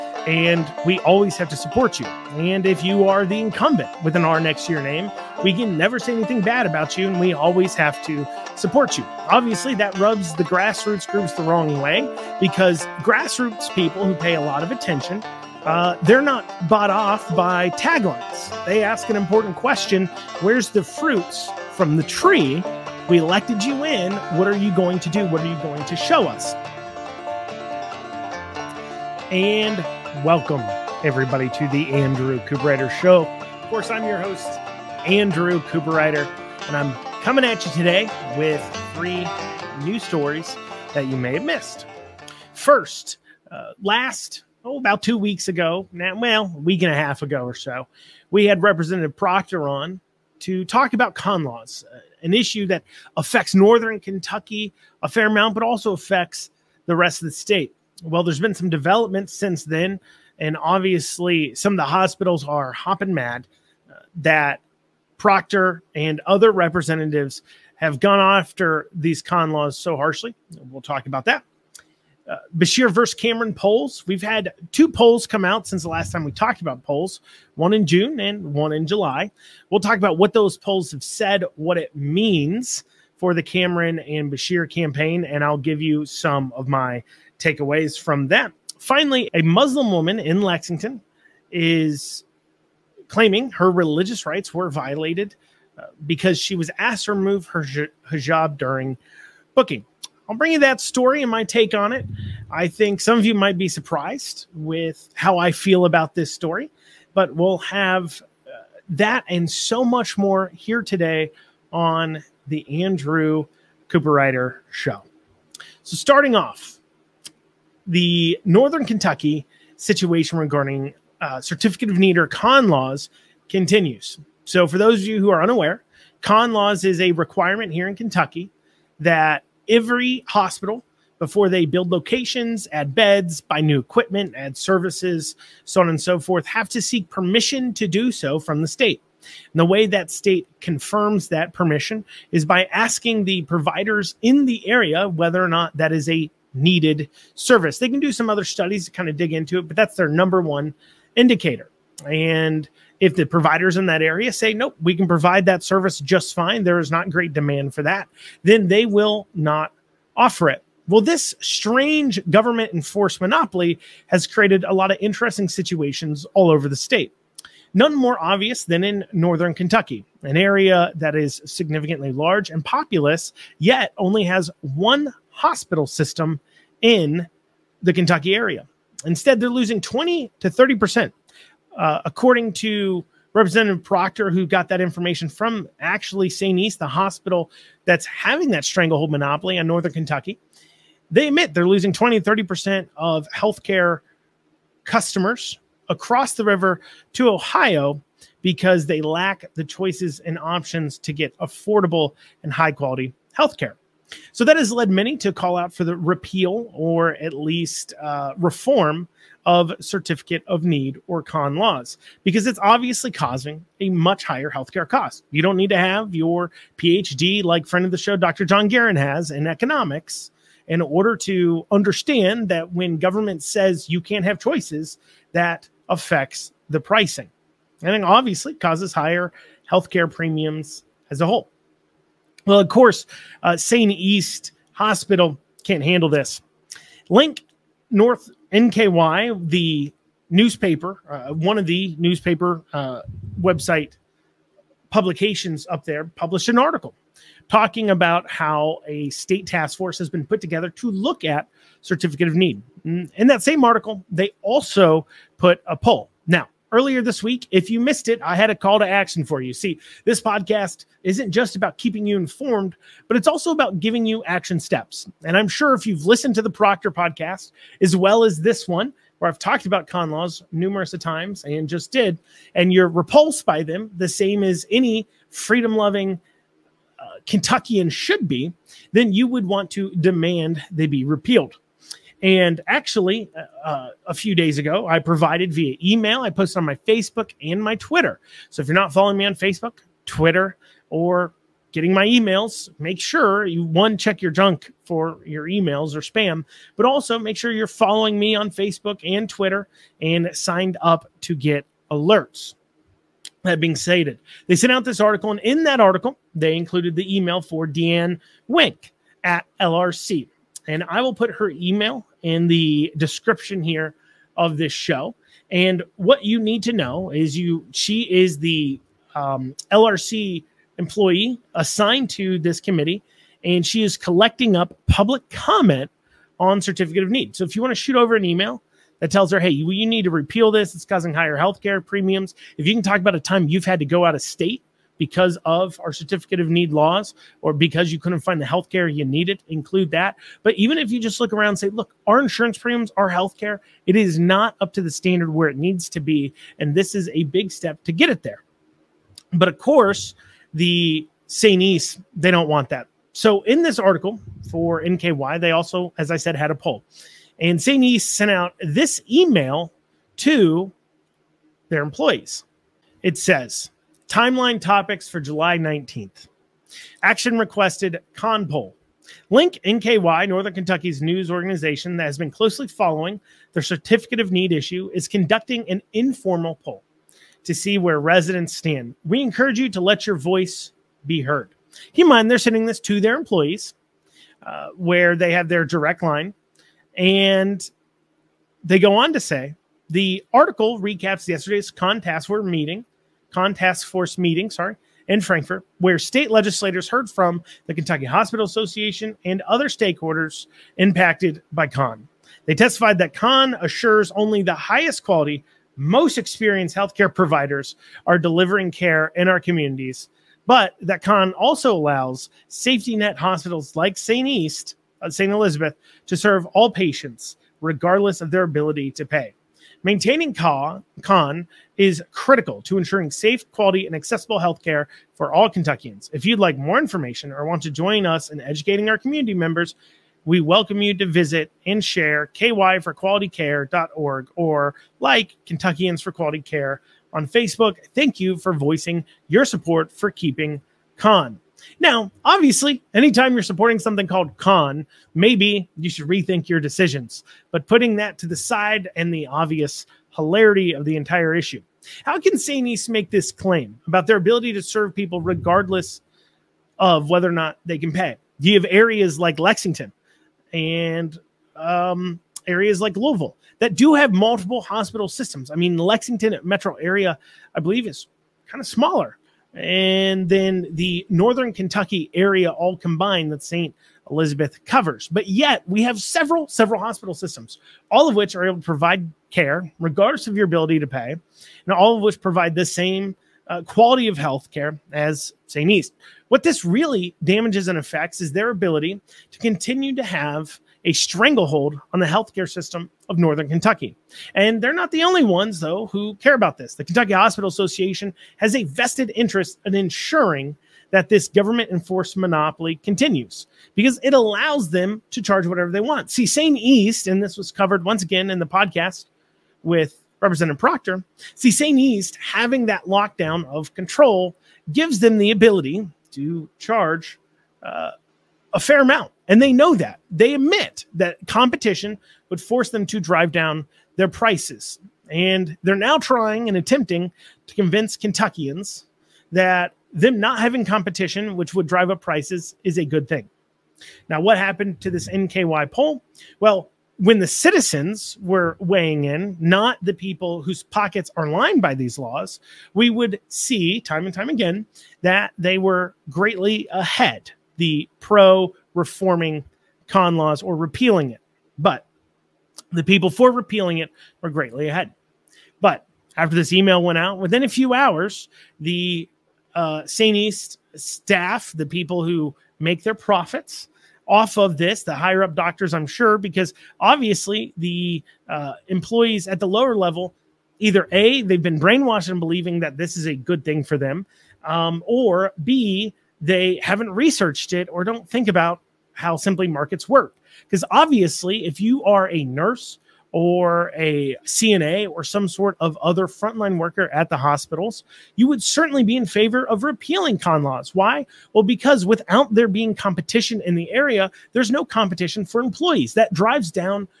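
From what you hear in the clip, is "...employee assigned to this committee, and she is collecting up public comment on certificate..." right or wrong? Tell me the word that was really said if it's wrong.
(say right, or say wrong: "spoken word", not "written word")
right.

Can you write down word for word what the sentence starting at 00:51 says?
Uh, an issue that affects northern Kentucky a fair amount, but also affects the rest of the state.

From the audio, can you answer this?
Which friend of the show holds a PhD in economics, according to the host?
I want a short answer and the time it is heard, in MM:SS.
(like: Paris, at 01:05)
Dr. John Garen, at 03:38.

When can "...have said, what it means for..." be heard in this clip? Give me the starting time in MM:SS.
01:20.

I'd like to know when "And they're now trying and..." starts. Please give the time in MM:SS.
08:45.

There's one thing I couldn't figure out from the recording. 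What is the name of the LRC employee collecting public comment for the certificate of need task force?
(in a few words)
Deeann Wenk.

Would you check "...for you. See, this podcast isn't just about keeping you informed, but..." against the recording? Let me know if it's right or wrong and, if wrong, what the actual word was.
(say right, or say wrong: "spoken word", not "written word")
right.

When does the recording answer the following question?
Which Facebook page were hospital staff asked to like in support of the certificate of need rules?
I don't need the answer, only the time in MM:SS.
07:15.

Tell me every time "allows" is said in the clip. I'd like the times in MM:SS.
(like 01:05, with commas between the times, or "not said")
06:51, 08:24.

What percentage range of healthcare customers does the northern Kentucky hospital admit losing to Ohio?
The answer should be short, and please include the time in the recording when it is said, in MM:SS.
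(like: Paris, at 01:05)
20 to 30%, at 02:59.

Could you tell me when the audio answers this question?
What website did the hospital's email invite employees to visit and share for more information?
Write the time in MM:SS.
07:12.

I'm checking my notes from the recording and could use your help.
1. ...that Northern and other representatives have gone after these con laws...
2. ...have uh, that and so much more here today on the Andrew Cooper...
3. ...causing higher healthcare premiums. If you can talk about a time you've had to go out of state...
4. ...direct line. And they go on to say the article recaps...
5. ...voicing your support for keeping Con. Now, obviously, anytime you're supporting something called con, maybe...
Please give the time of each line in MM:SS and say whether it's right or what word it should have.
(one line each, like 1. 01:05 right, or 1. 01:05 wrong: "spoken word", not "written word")
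1. 01:04 wrong: "Proctor", not "Northern"
2. 01:47 right
3. 05:30 right
4. 06:25 right
5. 07:18 right.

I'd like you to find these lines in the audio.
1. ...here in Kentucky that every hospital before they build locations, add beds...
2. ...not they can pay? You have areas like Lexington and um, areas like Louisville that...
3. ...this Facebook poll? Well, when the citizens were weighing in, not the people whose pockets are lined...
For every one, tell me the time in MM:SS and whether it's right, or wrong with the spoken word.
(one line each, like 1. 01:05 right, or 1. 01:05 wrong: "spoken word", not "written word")
1. 02:07 right
2. 07:37 right
3. 08:54 wrong: "NKY", not "Facebook".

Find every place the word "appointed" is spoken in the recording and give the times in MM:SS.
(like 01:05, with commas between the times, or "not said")
not said.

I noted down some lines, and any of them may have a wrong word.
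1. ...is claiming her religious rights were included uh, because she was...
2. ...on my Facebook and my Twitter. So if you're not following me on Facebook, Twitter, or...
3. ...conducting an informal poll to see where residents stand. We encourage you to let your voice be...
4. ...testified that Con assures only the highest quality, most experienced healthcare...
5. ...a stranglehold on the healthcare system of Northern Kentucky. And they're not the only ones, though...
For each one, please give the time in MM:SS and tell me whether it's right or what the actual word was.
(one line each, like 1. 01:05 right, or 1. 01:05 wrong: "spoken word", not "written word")
1. 01:31 wrong: "violated", not "included"
2. 04:46 right
3. 06:15 right
4. 06:42 right
5. 08:10 right.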